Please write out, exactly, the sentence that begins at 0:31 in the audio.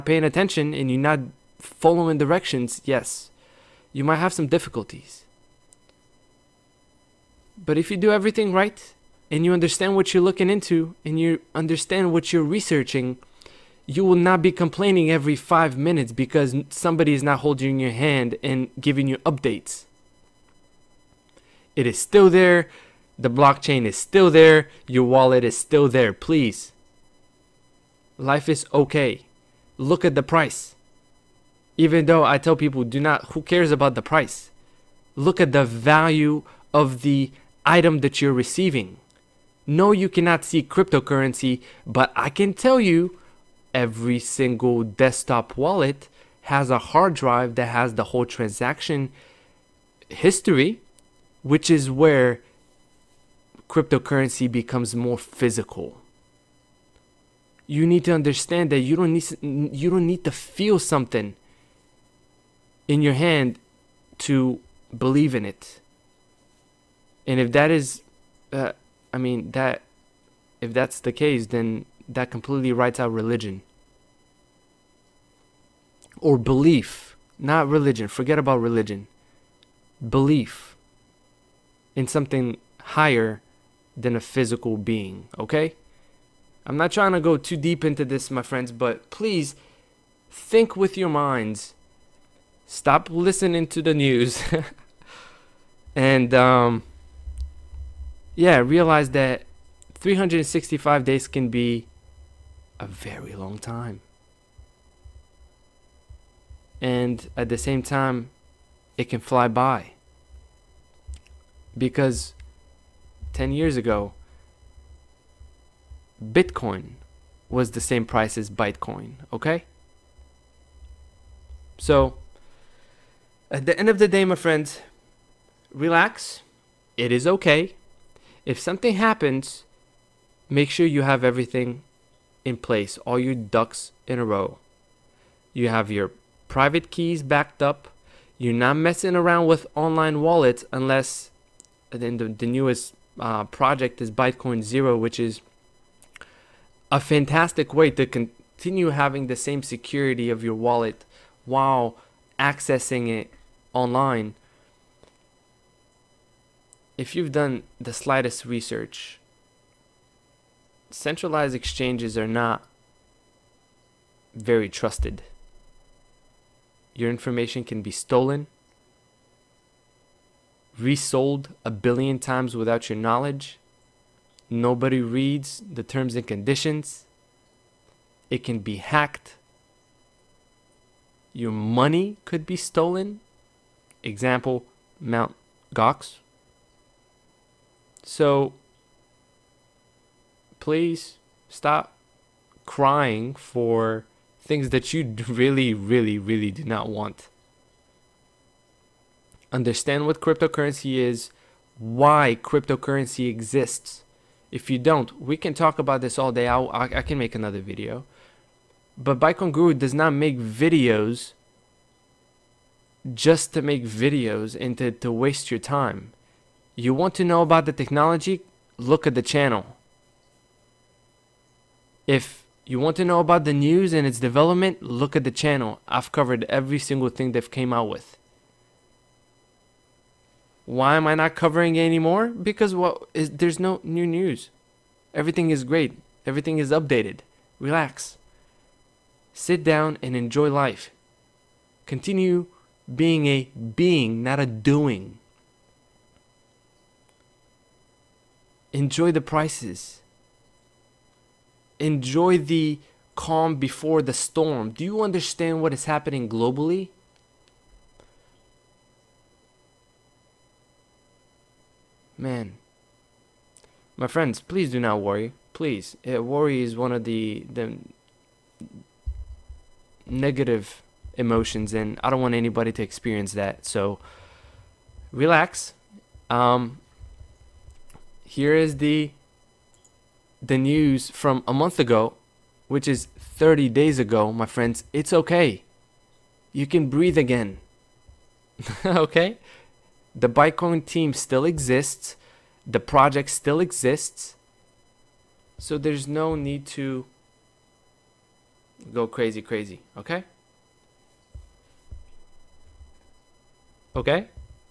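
Even though I tell people, do not, who cares about the price?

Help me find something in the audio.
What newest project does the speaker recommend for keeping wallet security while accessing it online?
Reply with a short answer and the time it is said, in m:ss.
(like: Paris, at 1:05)
Bytecoin Zero, at 2:24.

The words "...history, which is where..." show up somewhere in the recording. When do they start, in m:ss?
0:50.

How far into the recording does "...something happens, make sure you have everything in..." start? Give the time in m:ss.
2:08.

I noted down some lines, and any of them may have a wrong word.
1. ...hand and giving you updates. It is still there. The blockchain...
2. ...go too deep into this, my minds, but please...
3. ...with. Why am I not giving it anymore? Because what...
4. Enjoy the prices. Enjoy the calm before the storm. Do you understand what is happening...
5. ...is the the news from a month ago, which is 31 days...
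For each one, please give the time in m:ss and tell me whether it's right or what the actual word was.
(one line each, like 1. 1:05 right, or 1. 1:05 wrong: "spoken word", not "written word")
1. 0:17 right
2. 1:27 wrong: "friends", not "minds"
3. 3:47 wrong: "covering", not "giving"
4. 4:08 right
5. 4:38 wrong: "30", not "31".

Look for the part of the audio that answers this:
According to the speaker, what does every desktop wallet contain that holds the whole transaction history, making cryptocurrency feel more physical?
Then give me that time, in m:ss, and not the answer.
0:46.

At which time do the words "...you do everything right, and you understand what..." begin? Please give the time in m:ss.
0:07.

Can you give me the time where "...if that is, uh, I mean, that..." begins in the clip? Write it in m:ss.
1:07.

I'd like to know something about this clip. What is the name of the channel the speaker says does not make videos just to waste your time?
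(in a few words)
Bytecoin Guru.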